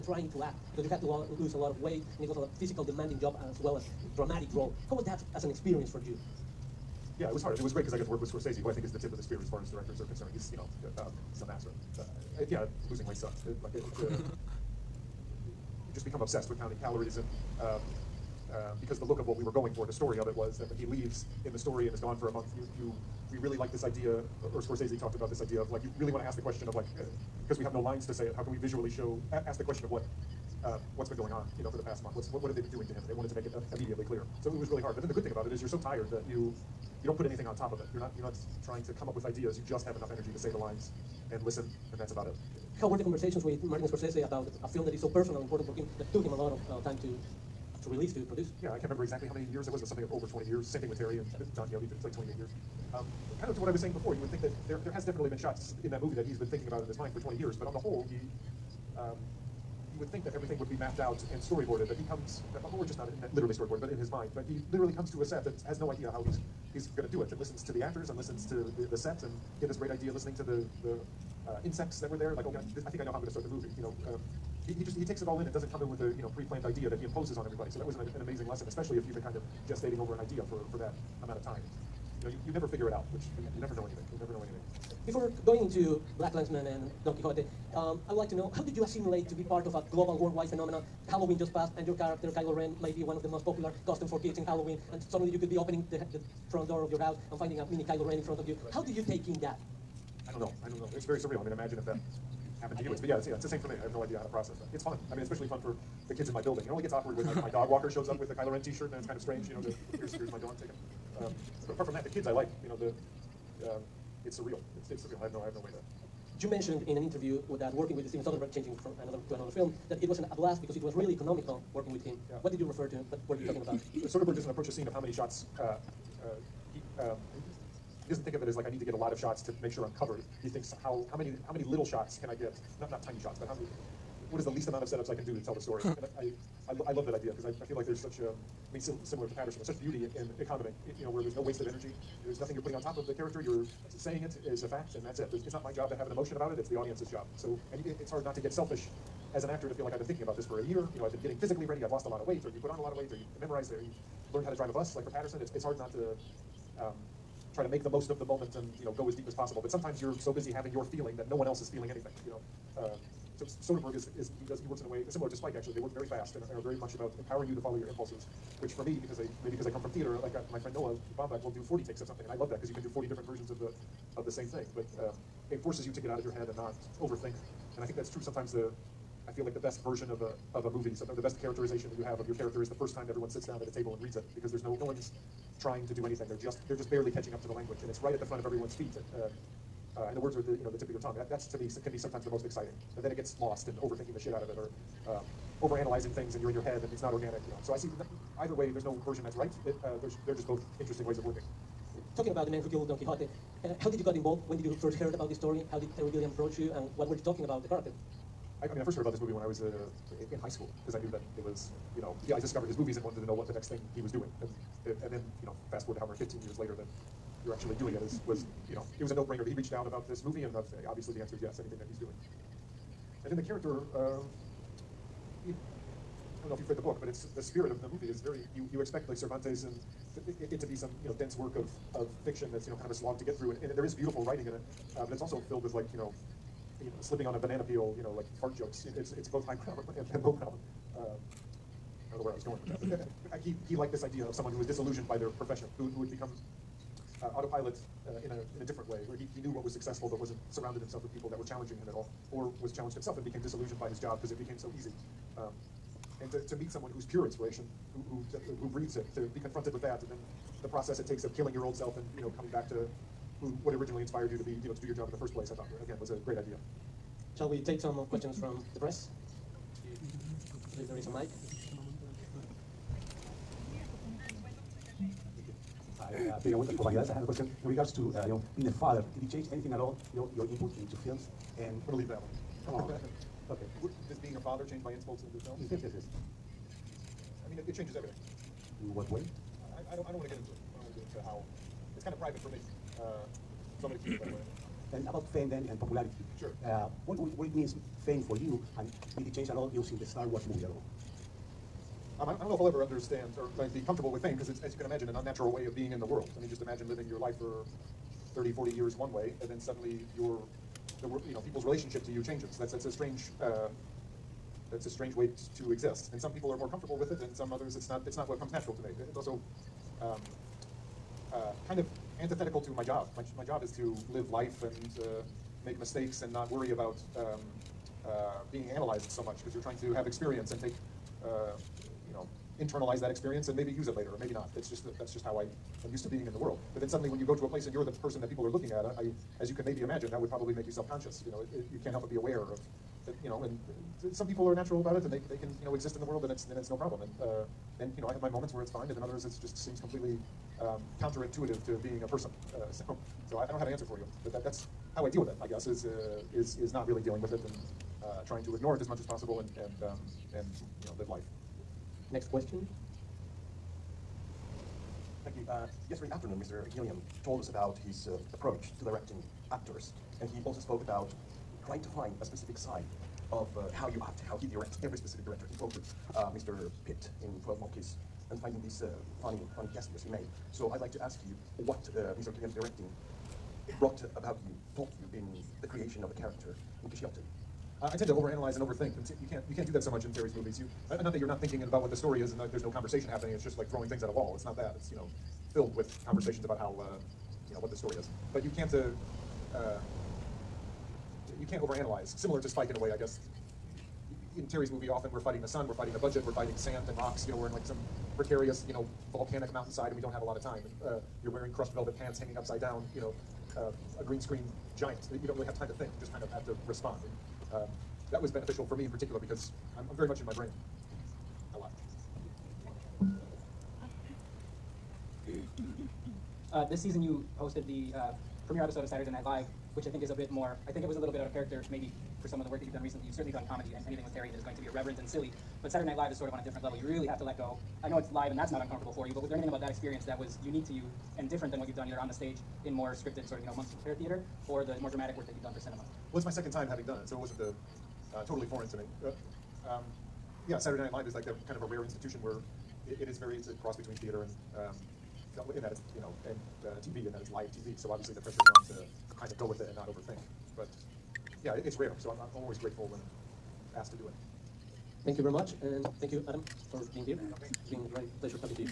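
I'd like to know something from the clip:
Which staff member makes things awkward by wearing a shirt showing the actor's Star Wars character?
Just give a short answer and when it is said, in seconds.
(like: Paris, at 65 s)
dog walker, at 107 s.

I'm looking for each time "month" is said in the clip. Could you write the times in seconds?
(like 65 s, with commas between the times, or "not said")
22 s, 32 s, 443 s.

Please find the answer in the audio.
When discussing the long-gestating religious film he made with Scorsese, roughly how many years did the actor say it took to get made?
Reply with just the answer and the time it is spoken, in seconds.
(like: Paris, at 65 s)
over 20 years, at 50 s.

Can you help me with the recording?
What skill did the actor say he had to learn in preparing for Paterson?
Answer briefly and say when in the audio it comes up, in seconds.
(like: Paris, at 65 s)
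drive a bus, at 154 s.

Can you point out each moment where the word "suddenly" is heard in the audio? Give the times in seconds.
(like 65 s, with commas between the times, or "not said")
95 s, 309 s, 336 s.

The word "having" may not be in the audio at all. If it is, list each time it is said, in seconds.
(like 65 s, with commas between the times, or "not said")
160 s, 446 s.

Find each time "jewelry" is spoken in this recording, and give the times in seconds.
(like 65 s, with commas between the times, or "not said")
not said.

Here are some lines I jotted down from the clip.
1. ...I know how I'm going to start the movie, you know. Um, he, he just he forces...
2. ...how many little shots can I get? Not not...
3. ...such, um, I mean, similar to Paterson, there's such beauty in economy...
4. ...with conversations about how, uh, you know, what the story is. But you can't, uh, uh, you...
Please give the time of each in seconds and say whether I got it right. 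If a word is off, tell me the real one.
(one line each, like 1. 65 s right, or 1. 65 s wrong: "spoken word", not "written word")
1. 72 s wrong: "takes", not "forces"
2. 131 s right
3. 137 s right
4. 395 s right.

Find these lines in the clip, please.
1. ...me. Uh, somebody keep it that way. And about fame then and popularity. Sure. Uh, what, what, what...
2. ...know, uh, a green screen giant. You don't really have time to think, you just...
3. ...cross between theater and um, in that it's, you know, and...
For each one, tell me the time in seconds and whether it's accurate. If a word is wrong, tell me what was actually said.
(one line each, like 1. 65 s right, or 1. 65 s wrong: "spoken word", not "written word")
1. 292 s right
2. 412 s right
3. 453 s right.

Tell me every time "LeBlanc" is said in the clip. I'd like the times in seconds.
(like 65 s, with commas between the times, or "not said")
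not said.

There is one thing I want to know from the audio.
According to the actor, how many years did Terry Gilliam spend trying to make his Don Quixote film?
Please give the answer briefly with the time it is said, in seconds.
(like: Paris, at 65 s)
28 years, at 52 s.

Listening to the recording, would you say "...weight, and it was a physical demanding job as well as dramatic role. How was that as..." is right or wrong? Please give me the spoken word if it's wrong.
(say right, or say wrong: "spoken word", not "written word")
right.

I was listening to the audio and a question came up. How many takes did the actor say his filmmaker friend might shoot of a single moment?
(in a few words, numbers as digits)
40.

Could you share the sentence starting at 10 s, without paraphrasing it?
He's, you know, um, he's a master.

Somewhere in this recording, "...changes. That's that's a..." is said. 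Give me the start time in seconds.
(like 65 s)
312 s.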